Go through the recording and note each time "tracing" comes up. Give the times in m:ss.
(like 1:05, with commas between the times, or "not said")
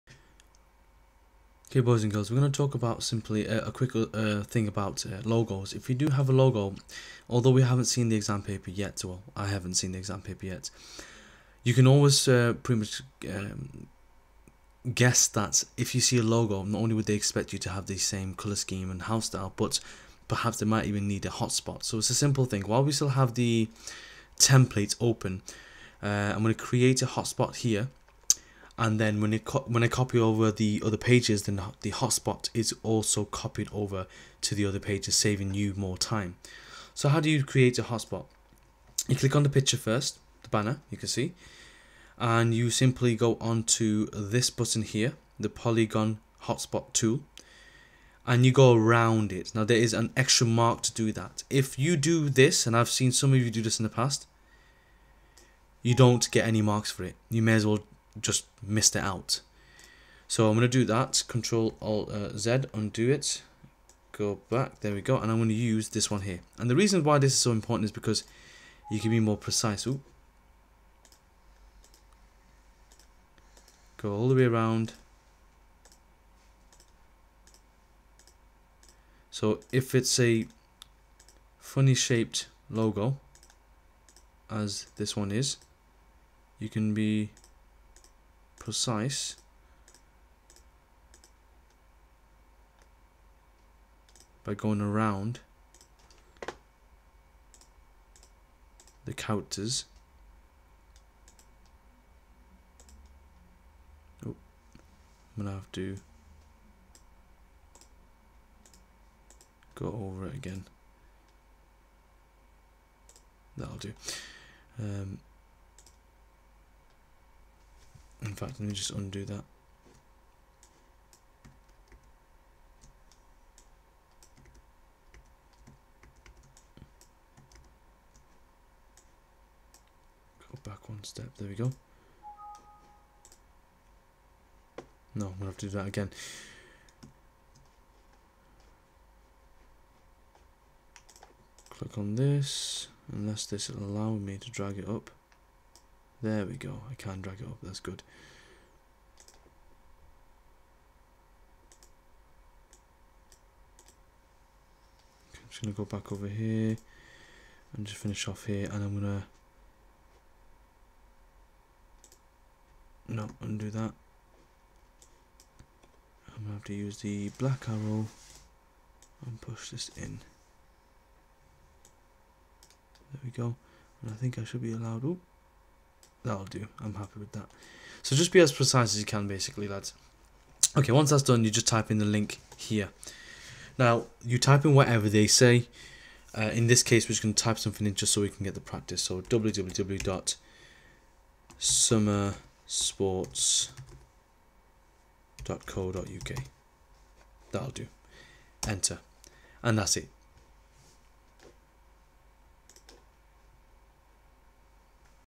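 not said.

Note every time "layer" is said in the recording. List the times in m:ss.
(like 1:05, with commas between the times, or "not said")
not said.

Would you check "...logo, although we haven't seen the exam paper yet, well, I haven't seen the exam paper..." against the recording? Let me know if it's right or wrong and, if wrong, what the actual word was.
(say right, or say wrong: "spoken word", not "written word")
right.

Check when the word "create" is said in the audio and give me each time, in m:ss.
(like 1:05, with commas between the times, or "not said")
0:26, 0:37.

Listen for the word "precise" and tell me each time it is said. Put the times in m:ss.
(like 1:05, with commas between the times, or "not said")
1:09, 1:28, 2:58.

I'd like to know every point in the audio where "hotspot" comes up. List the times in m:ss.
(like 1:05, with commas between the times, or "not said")
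0:21, 0:27, 0:31, 0:37, 0:46.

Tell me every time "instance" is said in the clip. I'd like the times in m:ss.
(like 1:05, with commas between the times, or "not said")
not said.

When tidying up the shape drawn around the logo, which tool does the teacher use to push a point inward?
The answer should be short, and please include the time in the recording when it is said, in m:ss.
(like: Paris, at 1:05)
Black arrow, at 2:47.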